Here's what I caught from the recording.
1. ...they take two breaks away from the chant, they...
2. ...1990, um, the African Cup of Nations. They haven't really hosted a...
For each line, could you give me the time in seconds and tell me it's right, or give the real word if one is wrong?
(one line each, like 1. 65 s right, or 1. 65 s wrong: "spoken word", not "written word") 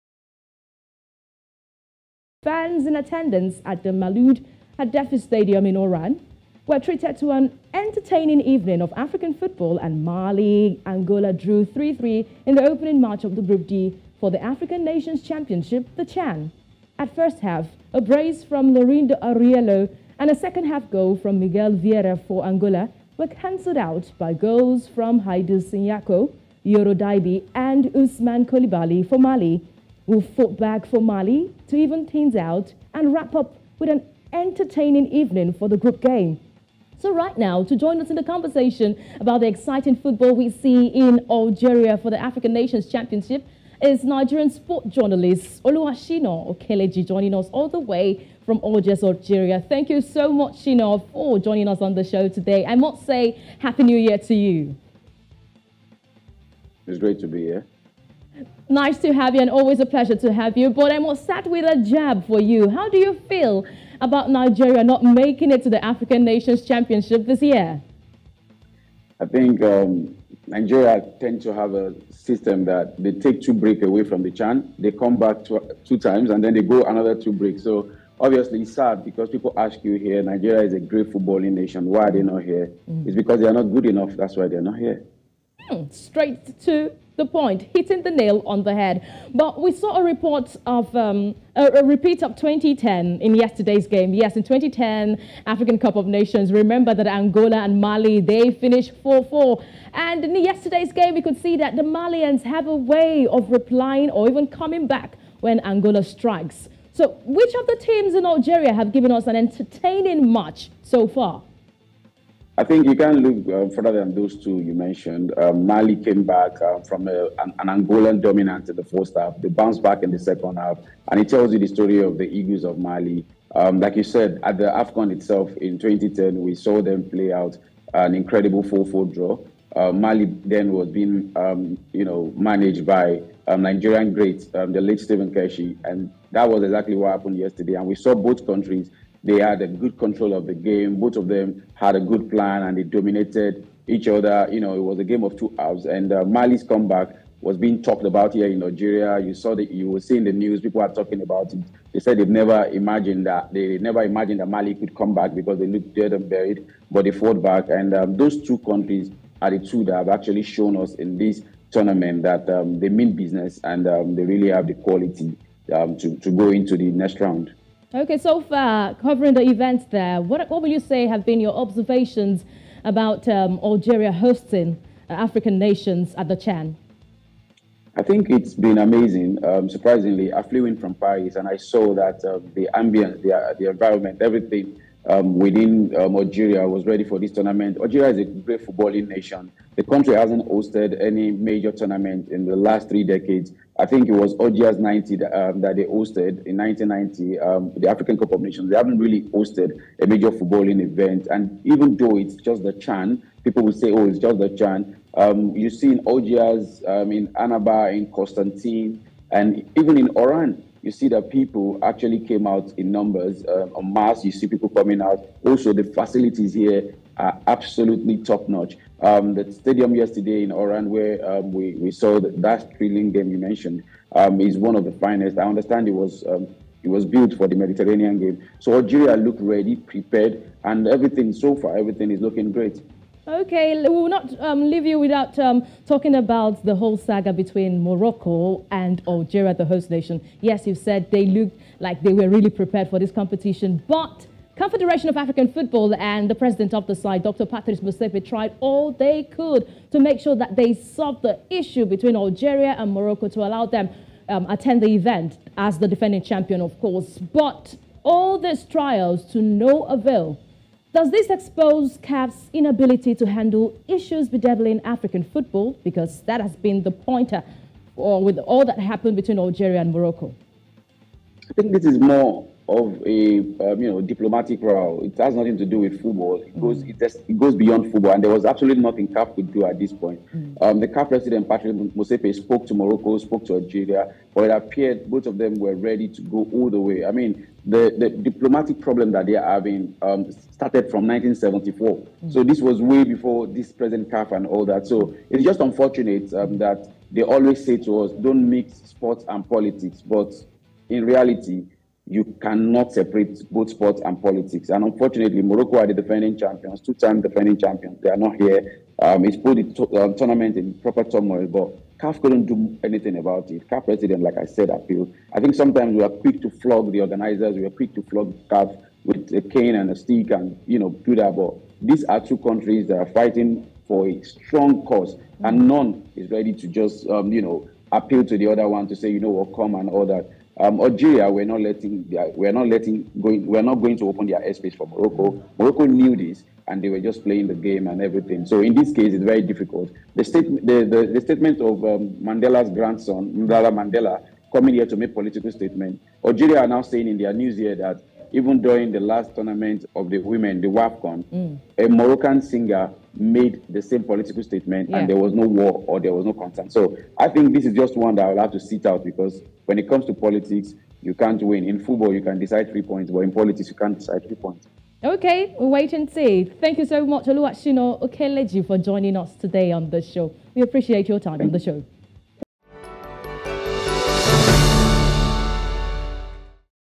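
1. 73 s right
2. 196 s right.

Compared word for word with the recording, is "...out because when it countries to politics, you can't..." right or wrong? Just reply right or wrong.
wrong.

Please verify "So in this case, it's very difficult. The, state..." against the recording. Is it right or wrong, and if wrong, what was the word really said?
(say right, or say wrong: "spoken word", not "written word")
right.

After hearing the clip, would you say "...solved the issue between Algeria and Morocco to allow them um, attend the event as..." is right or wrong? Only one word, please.
right.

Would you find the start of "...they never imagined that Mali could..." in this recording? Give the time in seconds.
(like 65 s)
153 s.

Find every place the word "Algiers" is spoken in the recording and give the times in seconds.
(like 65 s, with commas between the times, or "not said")
48 s, 206 s.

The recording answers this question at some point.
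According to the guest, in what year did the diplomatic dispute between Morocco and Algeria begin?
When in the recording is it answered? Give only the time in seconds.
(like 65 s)
291 s.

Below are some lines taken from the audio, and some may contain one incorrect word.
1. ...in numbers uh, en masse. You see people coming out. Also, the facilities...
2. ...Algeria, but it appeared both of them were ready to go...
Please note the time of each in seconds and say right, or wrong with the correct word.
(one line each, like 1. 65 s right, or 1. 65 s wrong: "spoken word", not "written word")
1. 212 s right
2. 283 s right.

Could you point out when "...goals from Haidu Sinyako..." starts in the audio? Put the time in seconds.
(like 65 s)
24 s.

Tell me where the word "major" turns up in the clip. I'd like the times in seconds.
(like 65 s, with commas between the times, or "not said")
191 s, 200 s.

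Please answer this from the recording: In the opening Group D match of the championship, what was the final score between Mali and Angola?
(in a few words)
3-3.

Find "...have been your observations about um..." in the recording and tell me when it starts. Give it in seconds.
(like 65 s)
171 s.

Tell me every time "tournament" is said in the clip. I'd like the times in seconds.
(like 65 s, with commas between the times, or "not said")
161 s, 187 s, 191 s, 310 s, 349 s.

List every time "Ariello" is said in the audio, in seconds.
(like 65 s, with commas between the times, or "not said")
19 s.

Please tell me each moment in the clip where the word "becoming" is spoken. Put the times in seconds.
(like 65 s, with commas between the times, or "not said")
not said.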